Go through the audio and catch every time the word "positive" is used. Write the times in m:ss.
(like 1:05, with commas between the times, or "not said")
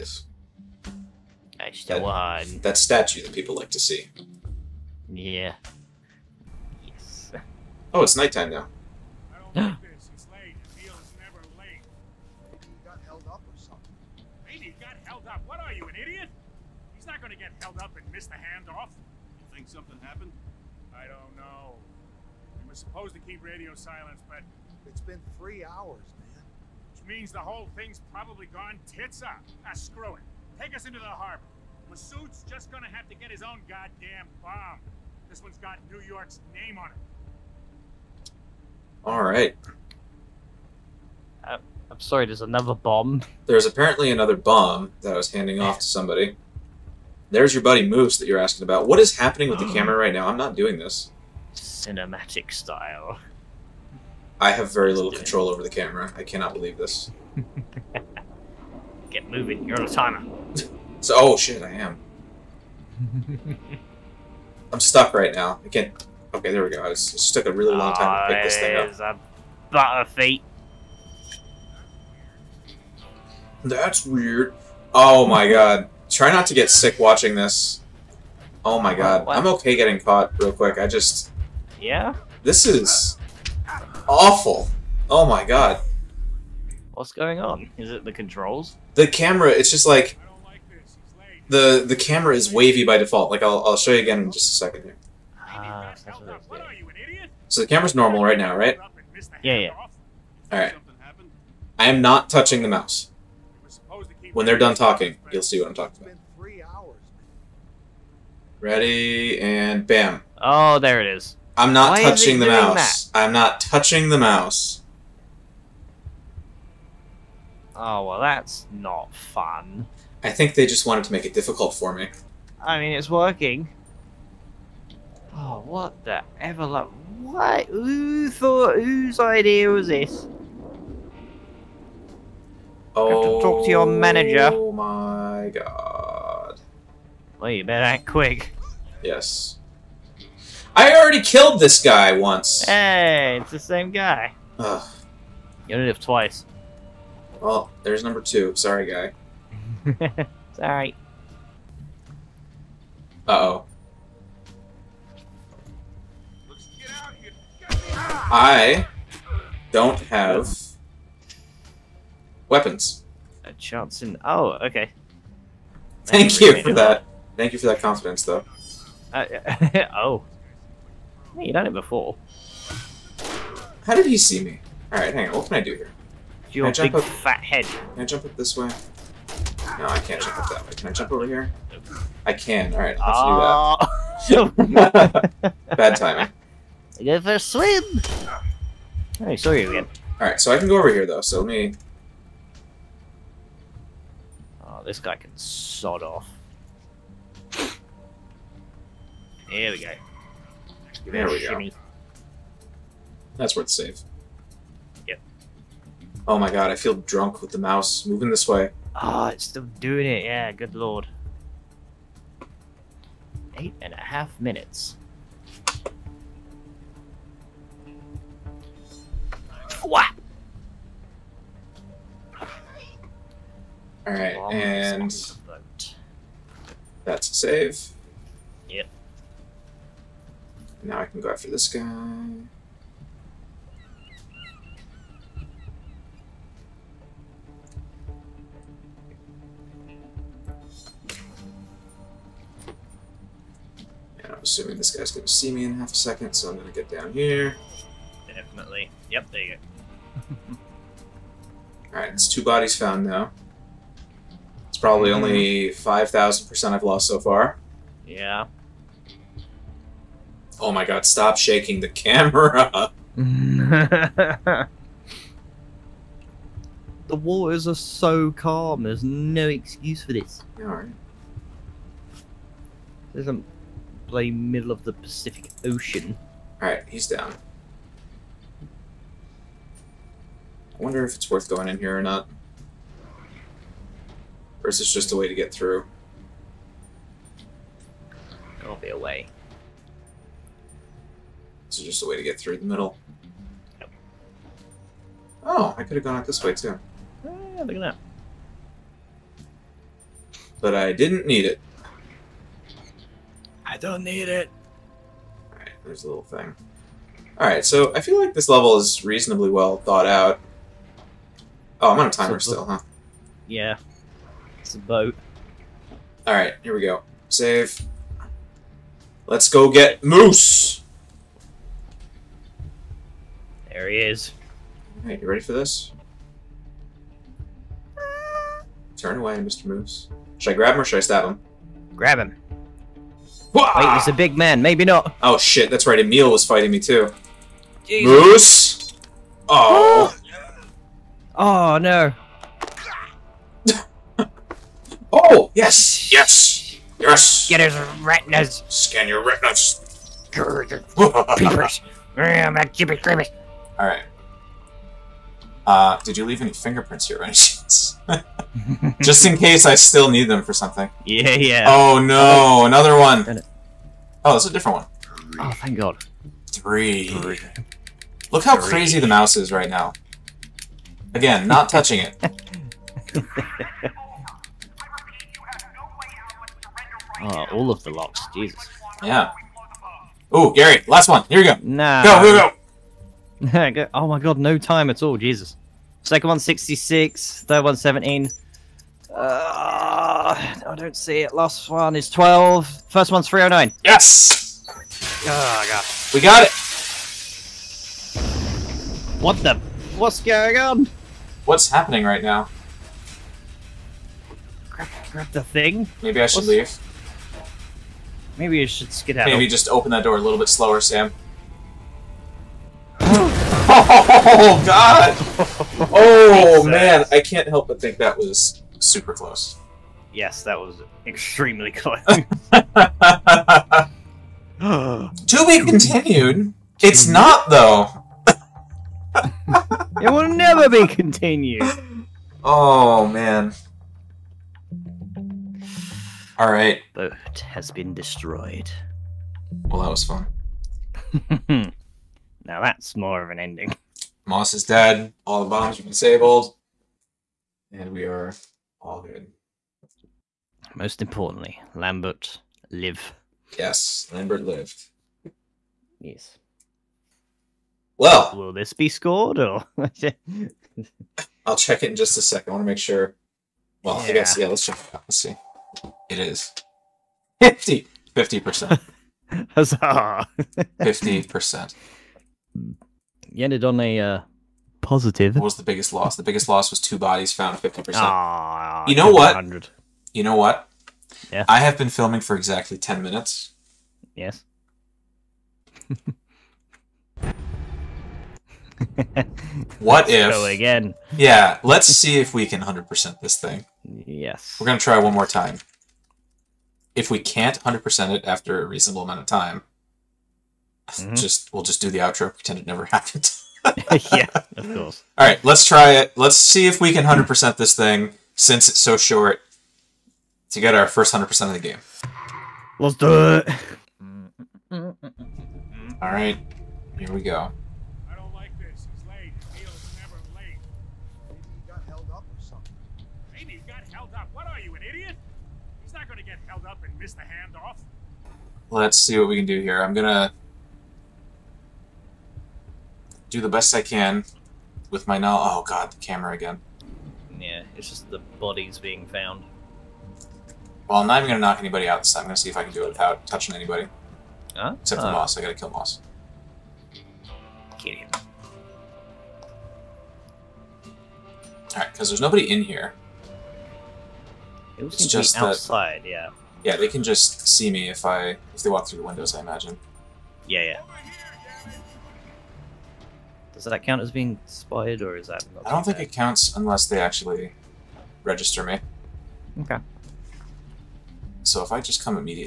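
7:54.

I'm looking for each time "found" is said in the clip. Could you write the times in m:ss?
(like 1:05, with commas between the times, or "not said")
4:12, 7:57, 8:59.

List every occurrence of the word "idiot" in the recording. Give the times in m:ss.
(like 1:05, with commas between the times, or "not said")
0:15, 8:44.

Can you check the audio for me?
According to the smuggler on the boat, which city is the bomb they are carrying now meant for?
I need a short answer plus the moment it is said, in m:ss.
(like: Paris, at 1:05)
New York, at 0:35.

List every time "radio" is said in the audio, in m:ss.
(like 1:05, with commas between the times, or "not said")
0:23.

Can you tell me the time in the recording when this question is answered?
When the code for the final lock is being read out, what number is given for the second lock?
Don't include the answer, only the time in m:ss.
6:26.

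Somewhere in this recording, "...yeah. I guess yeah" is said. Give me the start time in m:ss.
7:43.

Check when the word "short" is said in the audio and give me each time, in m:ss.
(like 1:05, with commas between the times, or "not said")
8:28.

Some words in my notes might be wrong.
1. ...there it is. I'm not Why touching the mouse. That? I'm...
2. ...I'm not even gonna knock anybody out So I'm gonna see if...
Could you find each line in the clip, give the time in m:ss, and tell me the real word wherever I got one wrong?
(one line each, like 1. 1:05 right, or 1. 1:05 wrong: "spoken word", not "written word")
1. 1:50 right
2. 9:00 right.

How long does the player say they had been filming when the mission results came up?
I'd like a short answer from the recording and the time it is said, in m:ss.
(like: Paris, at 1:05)
Ten minutes, at 8:02.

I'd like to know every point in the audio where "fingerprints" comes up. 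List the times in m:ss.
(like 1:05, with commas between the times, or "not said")
5:56.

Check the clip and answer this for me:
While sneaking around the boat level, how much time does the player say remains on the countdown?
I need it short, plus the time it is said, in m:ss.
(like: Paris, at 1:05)
Eight and a half minutes, at 3:33.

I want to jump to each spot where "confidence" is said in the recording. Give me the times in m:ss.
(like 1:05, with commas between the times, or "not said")
2:47.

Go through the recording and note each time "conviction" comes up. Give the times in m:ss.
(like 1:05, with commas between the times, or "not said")
not said.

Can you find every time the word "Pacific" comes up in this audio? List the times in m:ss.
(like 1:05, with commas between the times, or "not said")
4:34.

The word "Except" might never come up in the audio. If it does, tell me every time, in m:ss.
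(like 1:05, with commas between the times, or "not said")
9:04.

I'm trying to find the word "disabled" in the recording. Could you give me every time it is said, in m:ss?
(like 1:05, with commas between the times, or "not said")
7:25.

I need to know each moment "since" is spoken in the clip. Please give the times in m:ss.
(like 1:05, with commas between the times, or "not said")
8:28.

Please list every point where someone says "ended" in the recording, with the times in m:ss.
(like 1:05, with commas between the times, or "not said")
7:53.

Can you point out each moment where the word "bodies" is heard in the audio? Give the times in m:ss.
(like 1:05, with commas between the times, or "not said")
4:12, 7:56, 8:58.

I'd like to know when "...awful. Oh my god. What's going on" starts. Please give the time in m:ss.
1:24.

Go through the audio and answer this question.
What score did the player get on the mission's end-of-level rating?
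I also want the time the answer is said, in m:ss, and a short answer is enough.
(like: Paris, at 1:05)
50%, at 7:47.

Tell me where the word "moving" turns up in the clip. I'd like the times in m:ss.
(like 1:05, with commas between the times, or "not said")
0:59, 3:28.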